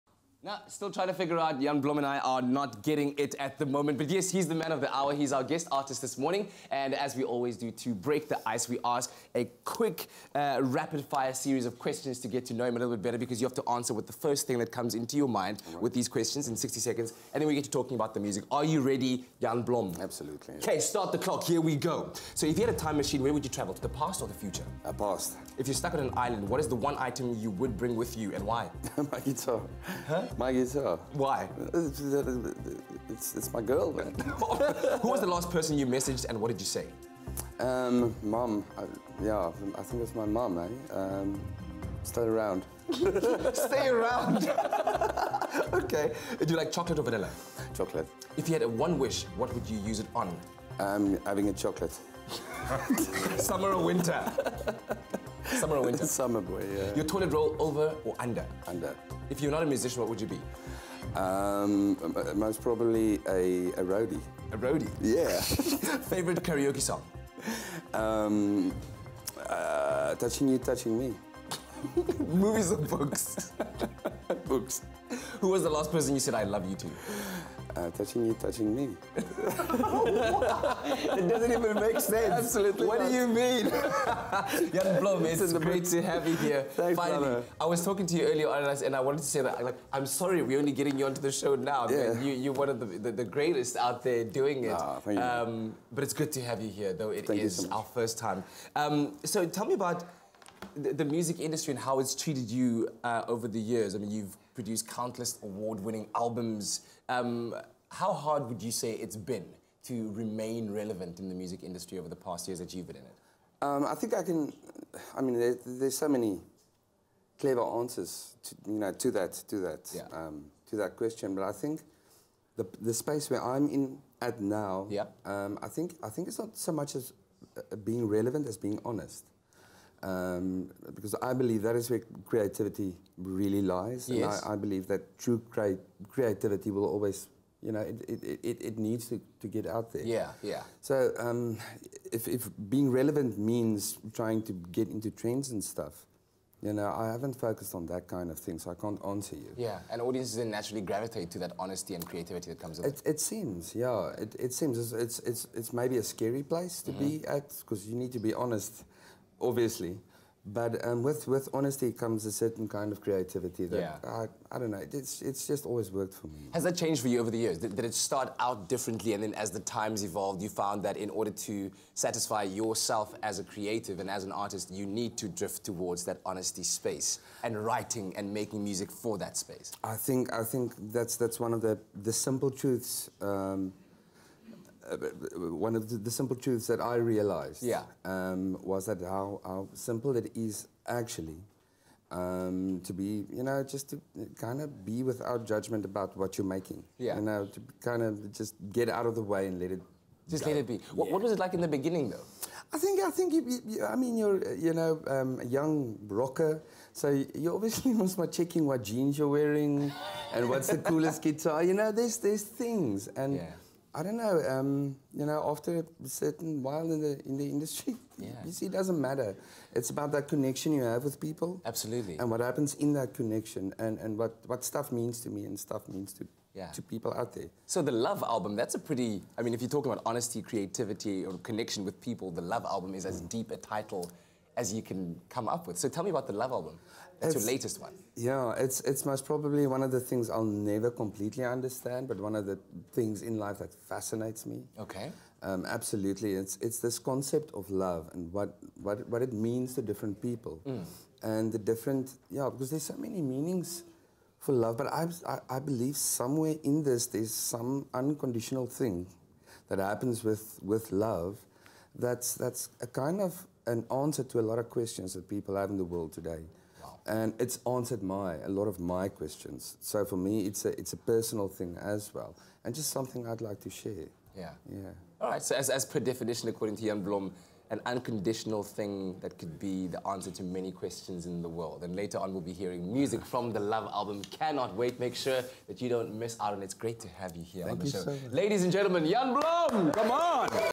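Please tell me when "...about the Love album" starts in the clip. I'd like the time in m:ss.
3:56.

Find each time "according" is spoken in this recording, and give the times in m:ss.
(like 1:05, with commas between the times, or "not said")
4:36.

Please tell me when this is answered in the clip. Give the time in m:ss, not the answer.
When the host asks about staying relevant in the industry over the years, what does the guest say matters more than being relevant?
2:08.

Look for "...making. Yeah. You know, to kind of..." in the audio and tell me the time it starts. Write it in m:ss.
3:16.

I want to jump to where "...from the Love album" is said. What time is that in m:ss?
4:43.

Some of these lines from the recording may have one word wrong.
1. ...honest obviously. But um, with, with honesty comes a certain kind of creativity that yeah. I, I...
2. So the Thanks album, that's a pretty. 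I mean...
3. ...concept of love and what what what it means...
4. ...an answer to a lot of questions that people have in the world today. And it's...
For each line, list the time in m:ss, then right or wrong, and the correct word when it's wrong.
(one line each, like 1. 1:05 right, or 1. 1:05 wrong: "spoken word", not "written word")
1. 2:38 right
2. 3:47 wrong: "Love", not "Thanks"
3. 4:06 right
4. 4:23 right.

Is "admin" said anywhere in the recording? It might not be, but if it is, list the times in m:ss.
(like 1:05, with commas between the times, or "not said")
not said.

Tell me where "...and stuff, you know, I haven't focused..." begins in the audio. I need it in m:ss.
2:25.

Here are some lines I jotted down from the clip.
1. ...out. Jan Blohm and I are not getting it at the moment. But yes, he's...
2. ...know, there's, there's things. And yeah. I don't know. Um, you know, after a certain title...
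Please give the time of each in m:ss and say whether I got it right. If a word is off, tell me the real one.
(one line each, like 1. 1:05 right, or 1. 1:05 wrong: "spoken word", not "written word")
1. 0:01 right
2. 3:31 wrong: "while", not "title".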